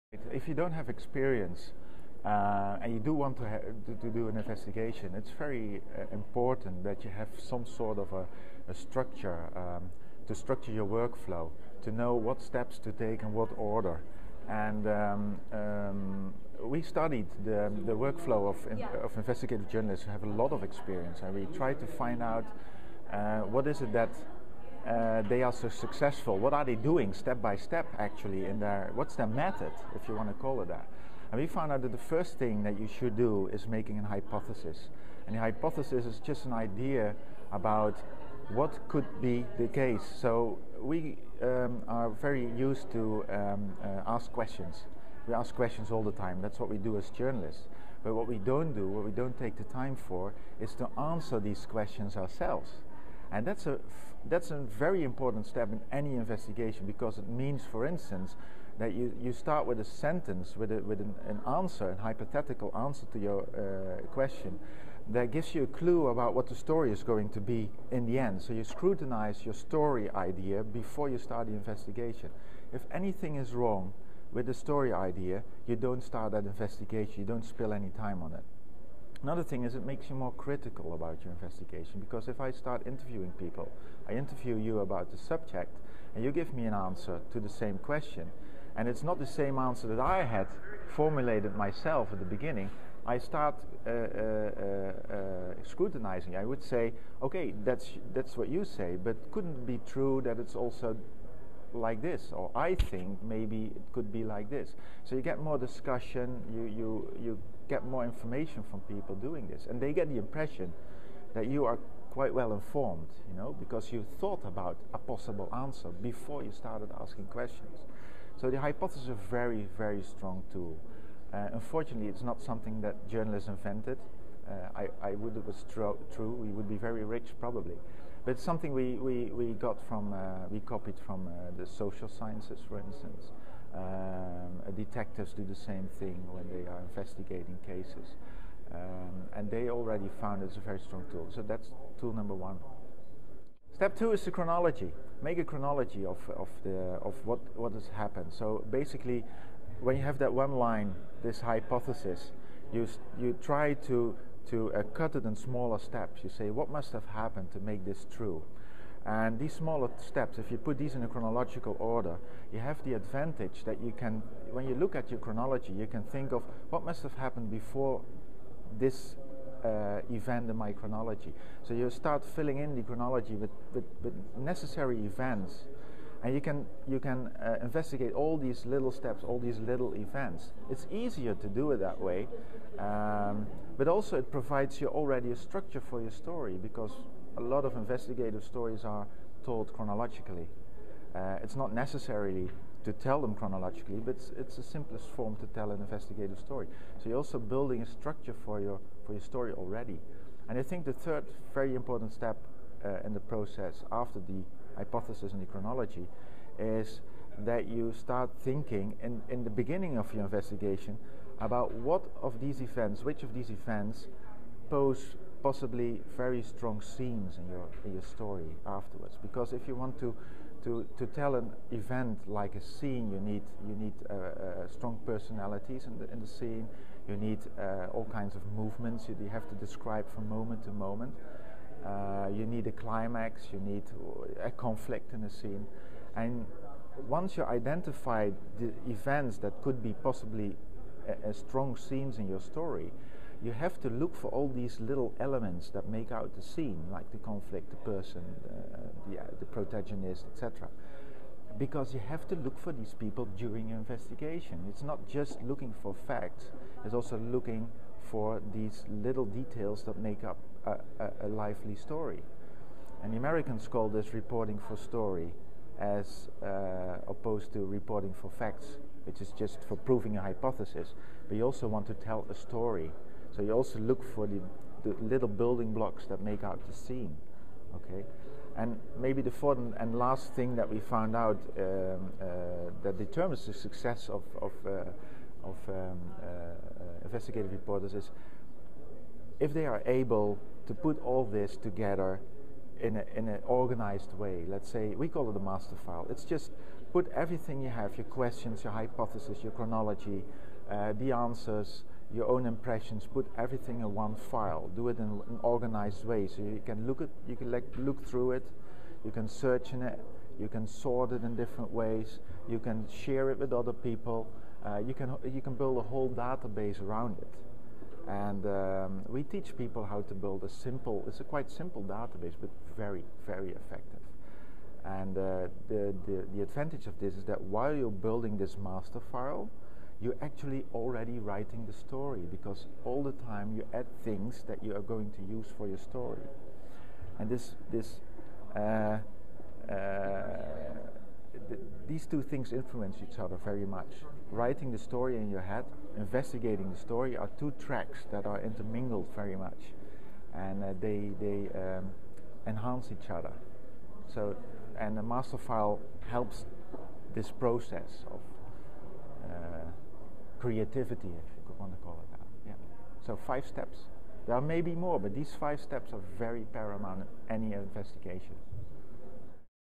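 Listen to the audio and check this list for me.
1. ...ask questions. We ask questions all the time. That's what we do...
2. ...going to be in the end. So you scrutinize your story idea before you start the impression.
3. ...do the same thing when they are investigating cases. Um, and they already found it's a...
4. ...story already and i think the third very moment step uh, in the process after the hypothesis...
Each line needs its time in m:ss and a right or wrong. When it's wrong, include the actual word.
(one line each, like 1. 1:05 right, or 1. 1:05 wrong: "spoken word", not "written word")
1. 0:44 right
2. 1:07 wrong: "investigation", not "impression"
3. 2:15 right
4. 3:19 wrong: "important", not "moment".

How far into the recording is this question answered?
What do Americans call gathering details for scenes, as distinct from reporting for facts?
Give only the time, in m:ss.
4:24.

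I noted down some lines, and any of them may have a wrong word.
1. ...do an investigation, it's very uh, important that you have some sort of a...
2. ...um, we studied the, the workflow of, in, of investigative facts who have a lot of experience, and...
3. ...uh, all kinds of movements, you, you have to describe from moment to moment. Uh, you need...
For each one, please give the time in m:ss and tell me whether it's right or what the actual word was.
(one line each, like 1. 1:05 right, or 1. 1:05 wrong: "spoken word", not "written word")
1. 0:04 right
2. 0:15 wrong: "journalists", not "facts"
3. 3:47 right.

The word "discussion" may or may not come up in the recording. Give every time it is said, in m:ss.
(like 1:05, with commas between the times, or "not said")
1:45.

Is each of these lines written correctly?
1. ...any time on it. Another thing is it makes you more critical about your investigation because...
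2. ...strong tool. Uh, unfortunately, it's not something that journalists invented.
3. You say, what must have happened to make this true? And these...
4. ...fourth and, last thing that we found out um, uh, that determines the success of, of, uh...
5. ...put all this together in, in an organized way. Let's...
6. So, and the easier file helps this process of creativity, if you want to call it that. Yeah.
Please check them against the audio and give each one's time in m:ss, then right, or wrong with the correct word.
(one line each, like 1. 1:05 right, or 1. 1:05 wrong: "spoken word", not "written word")
1. 1:17 right
2. 2:00 right
3. 2:36 right
4. 4:39 right
5. 4:50 right
6. 5:54 wrong: "master", not "easier".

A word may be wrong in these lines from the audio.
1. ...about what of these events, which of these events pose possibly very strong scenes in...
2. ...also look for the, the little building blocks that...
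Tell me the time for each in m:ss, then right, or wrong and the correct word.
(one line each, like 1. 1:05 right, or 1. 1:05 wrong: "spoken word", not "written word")
1. 3:31 right
2. 4:33 right.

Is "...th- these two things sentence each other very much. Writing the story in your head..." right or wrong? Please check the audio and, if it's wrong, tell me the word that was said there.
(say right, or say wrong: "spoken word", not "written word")
wrong: "influence", not "sentence".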